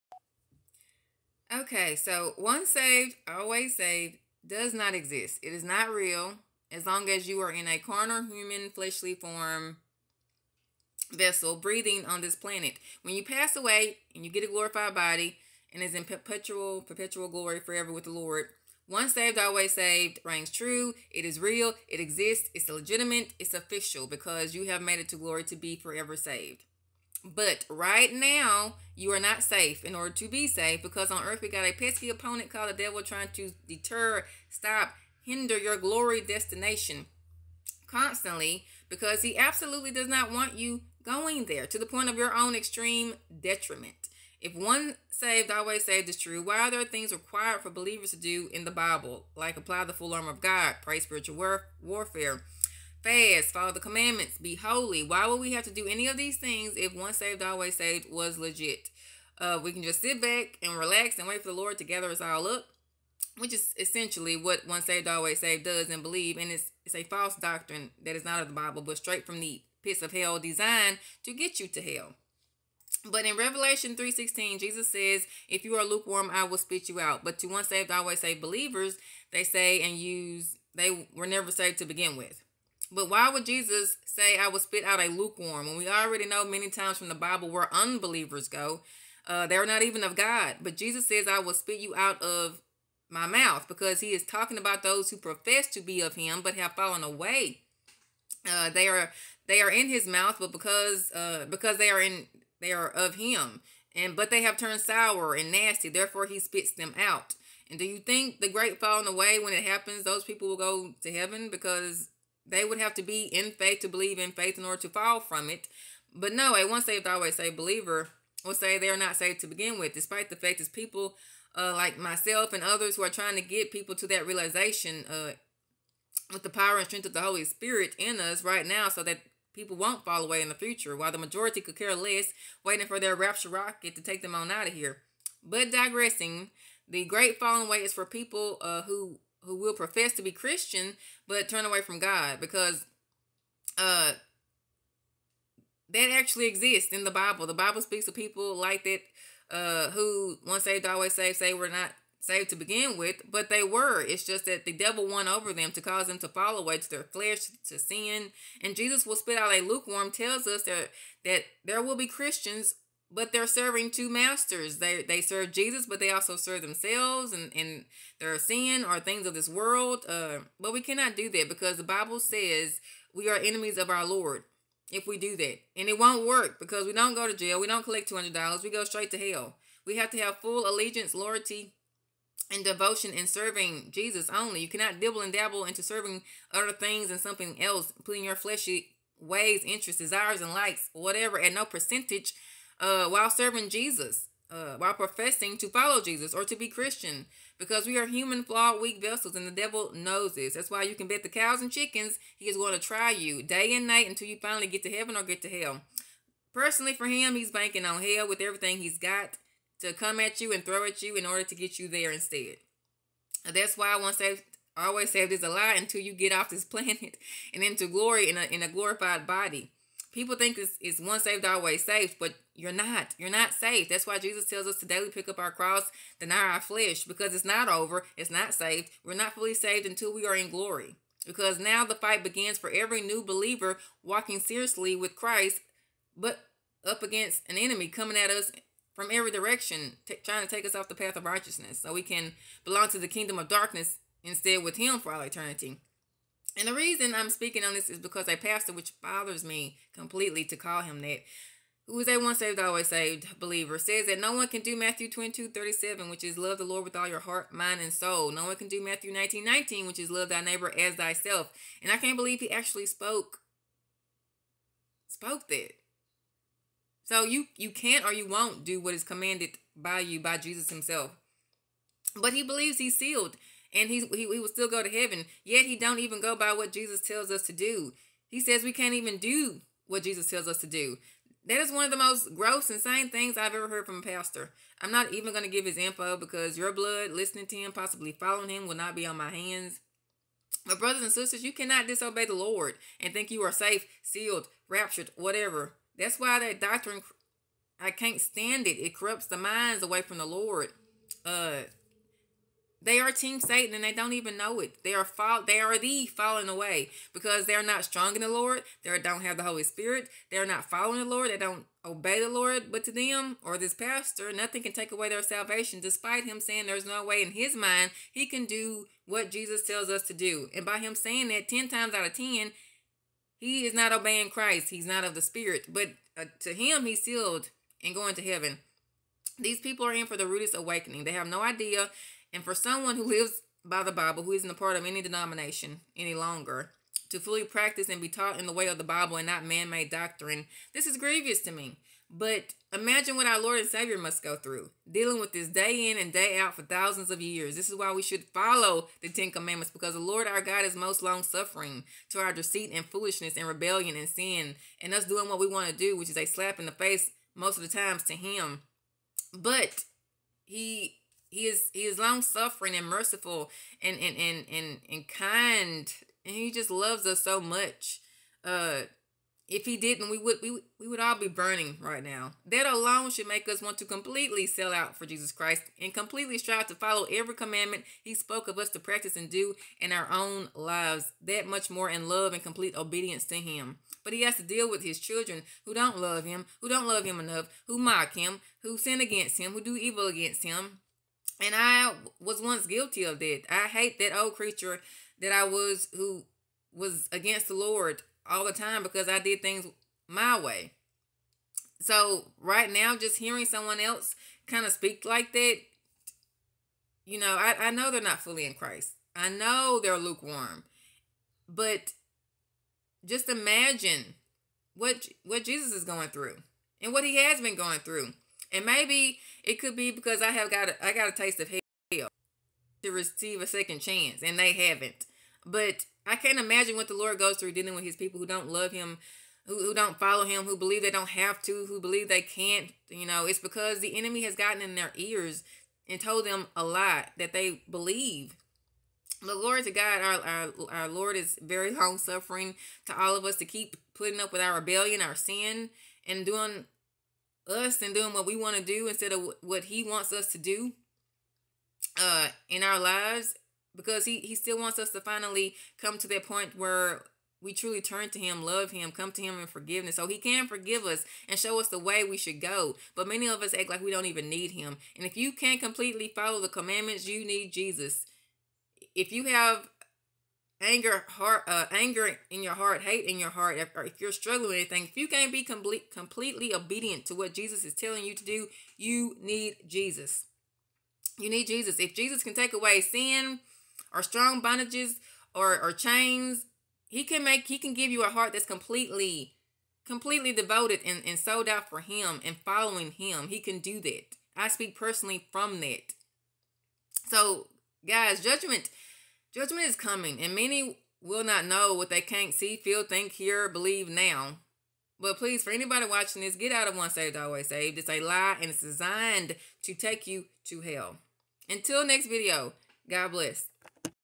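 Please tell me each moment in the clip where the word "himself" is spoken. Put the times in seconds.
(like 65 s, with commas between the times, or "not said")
270 s.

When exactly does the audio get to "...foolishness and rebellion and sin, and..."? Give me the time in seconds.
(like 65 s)
352 s.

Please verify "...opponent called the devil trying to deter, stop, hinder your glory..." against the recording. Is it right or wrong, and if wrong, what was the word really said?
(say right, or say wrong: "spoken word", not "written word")
right.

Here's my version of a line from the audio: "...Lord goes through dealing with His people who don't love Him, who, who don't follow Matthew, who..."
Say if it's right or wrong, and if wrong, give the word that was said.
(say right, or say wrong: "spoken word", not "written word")
wrong: "Him", not "Matthew".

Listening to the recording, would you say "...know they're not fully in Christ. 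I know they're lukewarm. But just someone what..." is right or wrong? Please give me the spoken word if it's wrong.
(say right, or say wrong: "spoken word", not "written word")
wrong: "imagine", not "someone".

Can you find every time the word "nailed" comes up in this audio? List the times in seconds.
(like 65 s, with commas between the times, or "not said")
not said.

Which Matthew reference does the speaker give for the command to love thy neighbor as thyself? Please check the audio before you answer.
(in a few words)
Matthew 19:19.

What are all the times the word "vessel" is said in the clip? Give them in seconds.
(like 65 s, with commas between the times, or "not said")
11 s, 198 s.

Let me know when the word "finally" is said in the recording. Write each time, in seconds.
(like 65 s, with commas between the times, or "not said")
204 s, 455 s.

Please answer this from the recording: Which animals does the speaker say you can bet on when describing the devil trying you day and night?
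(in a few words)
Cows and chickens.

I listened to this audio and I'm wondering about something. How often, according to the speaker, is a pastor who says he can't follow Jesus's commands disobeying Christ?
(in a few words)
10 times out of 10.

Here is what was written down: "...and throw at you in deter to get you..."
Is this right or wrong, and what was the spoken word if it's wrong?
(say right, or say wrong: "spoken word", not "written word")
wrong: "order", not "deter".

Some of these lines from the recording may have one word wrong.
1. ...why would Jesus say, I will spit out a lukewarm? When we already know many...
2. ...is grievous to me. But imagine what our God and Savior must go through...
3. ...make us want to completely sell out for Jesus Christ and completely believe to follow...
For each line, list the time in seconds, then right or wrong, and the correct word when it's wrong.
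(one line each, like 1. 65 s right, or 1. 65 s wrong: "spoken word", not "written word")
1. 83 s right
2. 340 s wrong: "Lord", not "God"
3. 373 s wrong: "strive", not "believe".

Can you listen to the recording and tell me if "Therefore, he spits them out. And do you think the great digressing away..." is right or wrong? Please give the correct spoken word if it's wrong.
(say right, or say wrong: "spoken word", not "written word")
wrong: "falling", not "digressing".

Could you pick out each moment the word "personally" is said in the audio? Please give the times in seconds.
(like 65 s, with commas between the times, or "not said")
206 s, 494 s.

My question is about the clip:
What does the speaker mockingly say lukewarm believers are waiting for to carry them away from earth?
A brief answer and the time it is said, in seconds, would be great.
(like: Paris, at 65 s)
Rapture rocket, at 133 s.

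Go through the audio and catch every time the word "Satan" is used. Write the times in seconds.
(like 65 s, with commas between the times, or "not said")
303 s.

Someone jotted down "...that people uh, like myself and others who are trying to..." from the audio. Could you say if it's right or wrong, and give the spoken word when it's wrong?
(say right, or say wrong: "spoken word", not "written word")
right.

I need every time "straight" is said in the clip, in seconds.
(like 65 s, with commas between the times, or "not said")
68 s, 178 s.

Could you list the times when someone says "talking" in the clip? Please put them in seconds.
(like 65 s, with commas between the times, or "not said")
94 s.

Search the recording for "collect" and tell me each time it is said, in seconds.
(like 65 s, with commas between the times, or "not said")
177 s.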